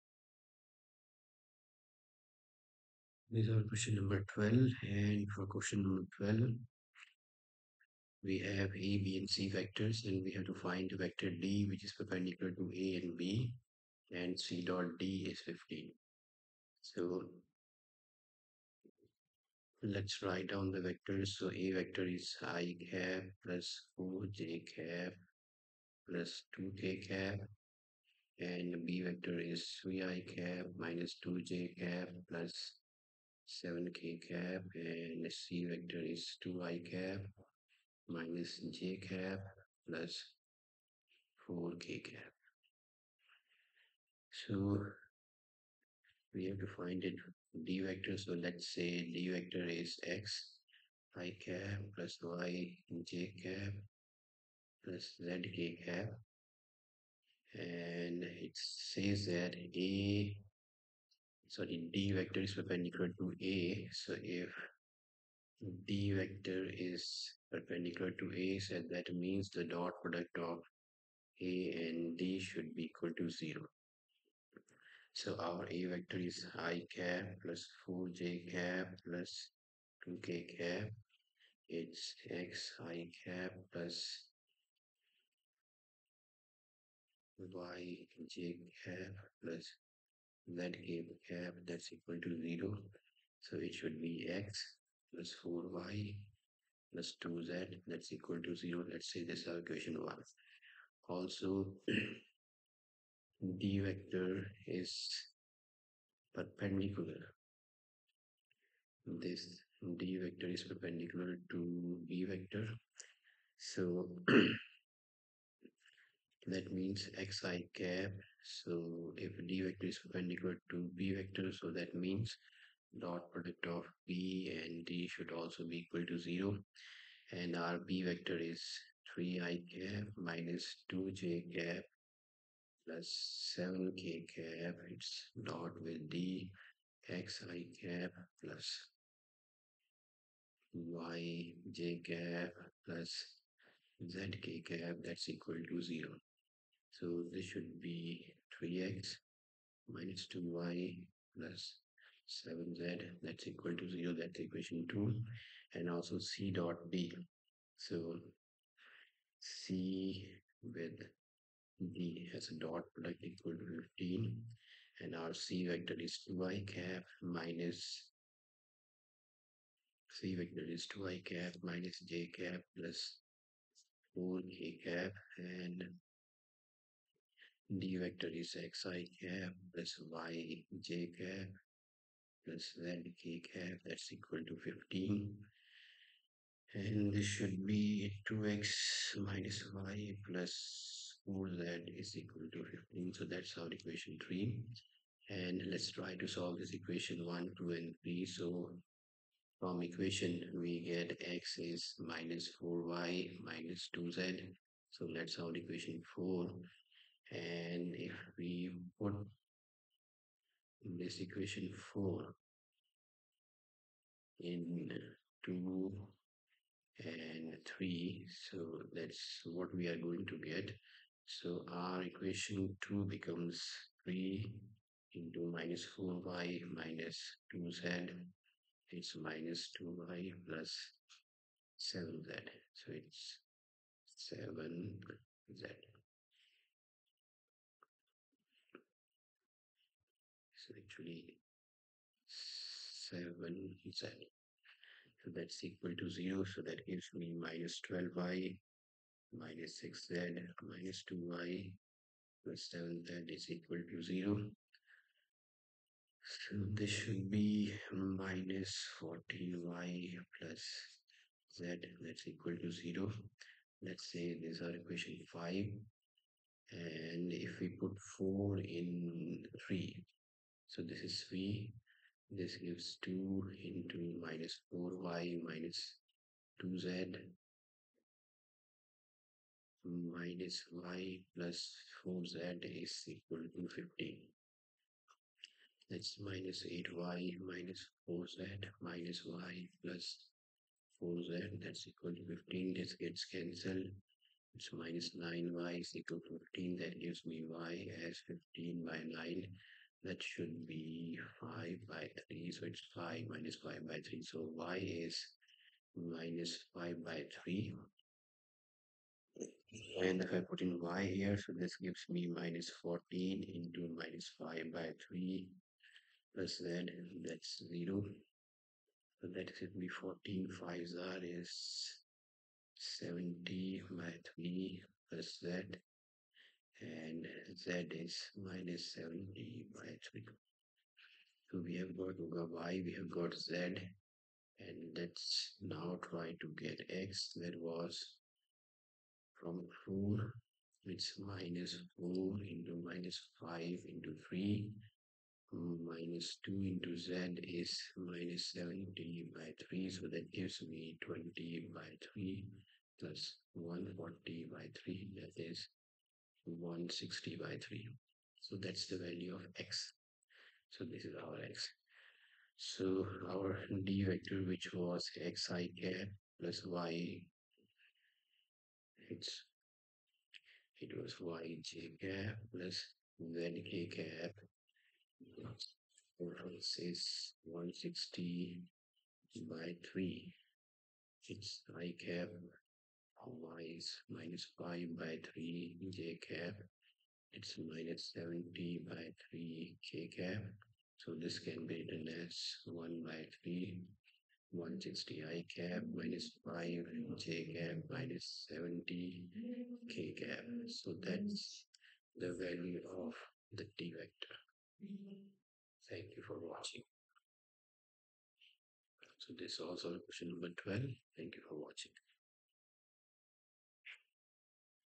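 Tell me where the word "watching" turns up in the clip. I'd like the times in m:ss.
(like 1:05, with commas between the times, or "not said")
6:46, 6:51.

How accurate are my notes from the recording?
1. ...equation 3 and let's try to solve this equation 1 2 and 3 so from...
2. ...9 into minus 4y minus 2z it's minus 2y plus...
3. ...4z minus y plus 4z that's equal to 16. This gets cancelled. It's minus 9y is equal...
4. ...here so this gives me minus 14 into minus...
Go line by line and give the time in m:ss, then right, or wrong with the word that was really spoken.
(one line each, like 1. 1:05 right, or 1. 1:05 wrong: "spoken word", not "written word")
1. 3:13 right
2. 3:44 wrong: "3", not "9"
3. 4:48 wrong: "15", not "16"
4. 5:11 right.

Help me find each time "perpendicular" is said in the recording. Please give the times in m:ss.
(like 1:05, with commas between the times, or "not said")
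0:11, 1:02, 1:07, 1:46, 1:50, 2:00.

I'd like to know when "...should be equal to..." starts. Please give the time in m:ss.
1:12.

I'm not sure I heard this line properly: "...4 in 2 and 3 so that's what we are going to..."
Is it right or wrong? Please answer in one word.
right.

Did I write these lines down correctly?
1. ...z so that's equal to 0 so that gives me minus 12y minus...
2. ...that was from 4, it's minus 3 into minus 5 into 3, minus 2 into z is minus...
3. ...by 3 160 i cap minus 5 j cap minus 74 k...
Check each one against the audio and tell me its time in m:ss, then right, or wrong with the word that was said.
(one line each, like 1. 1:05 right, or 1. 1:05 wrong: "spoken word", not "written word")
1. 4:03 right
2. 5:37 wrong: "4", not "3"
3. 6:33 wrong: "70", not "74".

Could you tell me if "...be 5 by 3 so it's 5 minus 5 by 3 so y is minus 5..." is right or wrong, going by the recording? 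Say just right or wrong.
right.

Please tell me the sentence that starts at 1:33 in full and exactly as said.
So it should be x plus 4y plus 2z that's equal to 0.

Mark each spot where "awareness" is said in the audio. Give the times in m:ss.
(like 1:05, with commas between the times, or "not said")
not said.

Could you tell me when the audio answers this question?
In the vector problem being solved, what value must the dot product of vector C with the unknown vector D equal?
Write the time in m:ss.
0:14.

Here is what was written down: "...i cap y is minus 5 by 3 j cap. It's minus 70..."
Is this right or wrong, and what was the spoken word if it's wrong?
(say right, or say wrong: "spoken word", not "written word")
right.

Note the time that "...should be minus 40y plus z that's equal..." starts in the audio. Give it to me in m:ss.
4:16.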